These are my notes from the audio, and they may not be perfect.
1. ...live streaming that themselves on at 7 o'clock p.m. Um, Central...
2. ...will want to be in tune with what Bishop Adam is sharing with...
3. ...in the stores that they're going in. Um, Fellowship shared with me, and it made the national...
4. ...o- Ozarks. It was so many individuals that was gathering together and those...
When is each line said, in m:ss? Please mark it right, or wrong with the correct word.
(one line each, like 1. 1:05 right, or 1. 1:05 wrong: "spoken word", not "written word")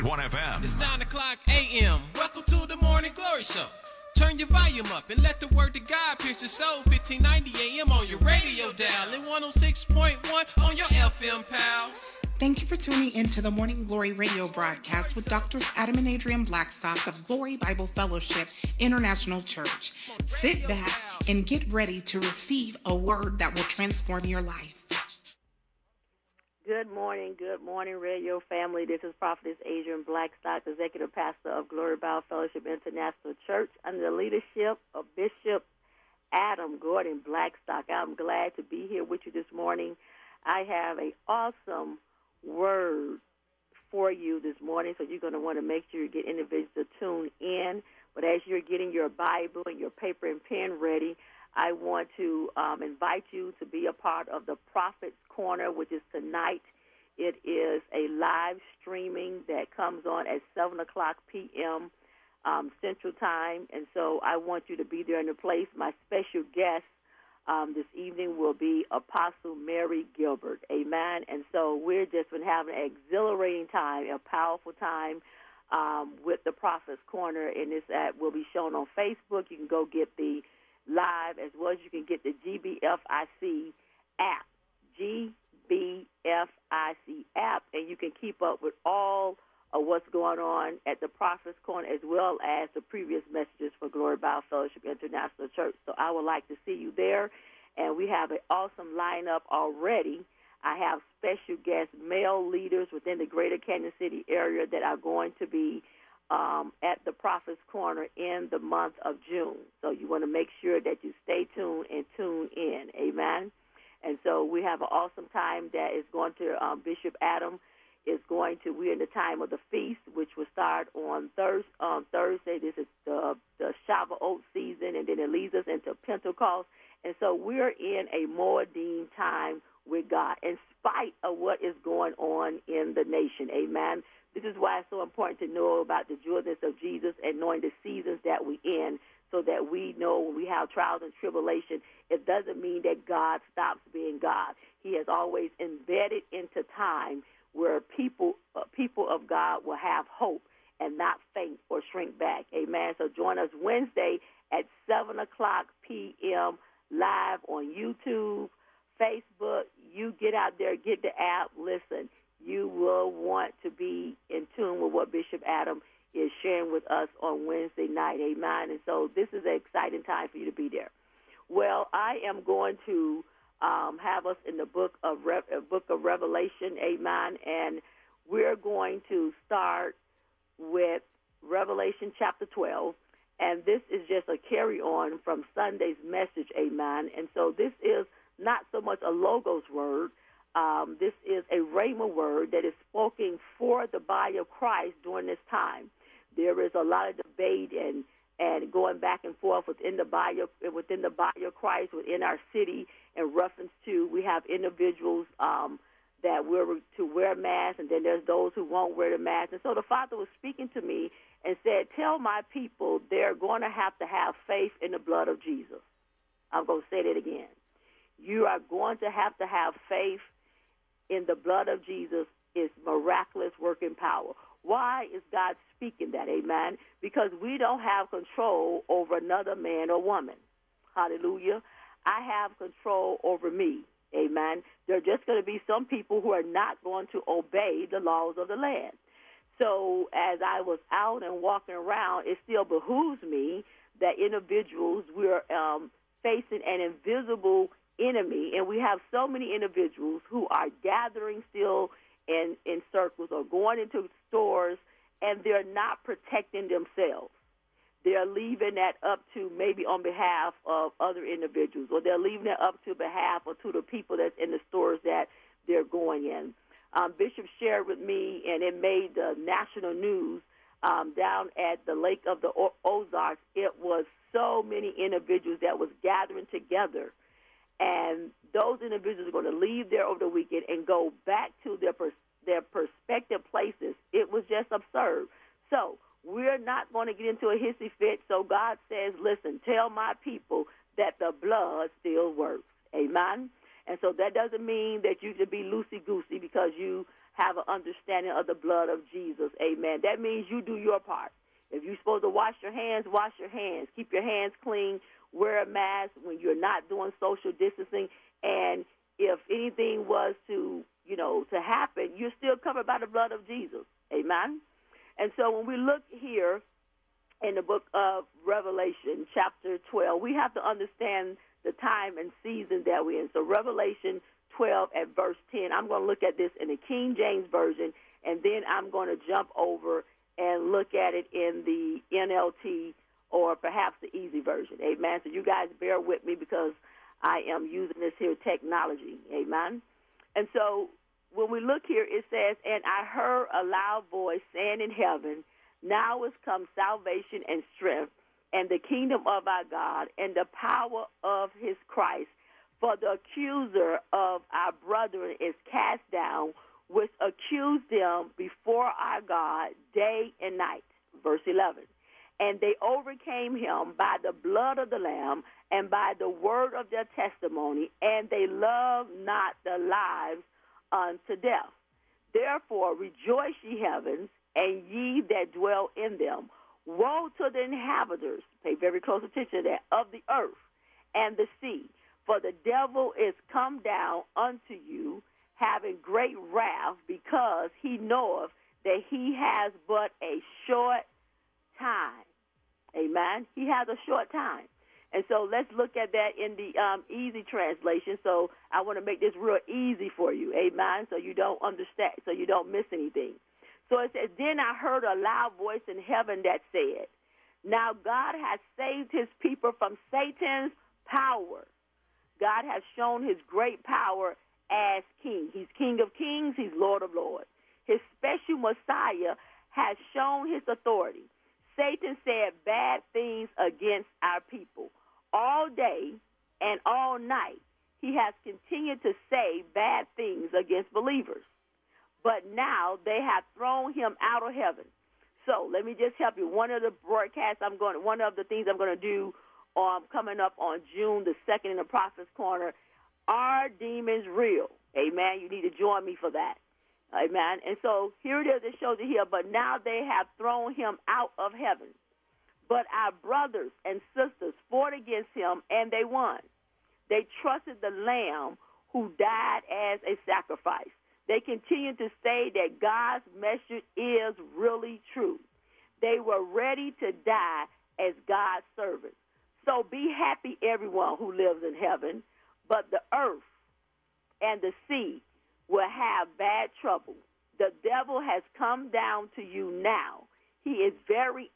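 1. 0:58 wrong: "comes", not "themselves"
2. 2:42 right
3. 4:24 wrong: "Bishop", not "Fellowship"
4. 4:32 right.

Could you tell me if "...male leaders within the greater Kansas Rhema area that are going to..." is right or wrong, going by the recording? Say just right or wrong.
wrong.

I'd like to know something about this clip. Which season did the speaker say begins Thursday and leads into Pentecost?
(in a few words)
Shavuot.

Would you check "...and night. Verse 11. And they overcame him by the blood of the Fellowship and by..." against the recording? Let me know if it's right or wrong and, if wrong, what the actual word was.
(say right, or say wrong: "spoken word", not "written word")
wrong: "Lamb", not "Fellowship".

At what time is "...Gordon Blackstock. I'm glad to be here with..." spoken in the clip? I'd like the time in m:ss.
0:36.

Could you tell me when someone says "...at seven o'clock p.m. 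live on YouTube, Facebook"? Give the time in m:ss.
2:34.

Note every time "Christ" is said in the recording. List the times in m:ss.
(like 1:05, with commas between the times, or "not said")
3:14, 3:21, 5:51.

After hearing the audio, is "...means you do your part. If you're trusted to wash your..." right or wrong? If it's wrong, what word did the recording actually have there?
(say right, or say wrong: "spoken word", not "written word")
wrong: "supposed", not "trusted".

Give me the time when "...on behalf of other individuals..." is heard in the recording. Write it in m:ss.
4:19.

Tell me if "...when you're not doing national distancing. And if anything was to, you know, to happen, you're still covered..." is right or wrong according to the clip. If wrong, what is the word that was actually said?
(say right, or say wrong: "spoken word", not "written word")
wrong: "social", not "national".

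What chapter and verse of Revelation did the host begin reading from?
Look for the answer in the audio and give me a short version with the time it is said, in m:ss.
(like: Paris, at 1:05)
Revelation 12:10, at 5:23.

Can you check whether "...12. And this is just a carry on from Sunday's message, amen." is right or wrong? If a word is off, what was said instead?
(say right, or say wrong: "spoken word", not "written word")
right.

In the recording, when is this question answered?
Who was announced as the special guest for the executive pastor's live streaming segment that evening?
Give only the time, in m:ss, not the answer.
1:08.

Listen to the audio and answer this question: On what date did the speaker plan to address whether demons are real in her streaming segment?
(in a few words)
June 2.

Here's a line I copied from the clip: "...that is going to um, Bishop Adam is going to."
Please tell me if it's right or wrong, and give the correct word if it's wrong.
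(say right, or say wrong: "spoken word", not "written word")
right.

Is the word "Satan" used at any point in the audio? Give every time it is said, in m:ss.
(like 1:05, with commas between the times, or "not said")
6:50, 7:01.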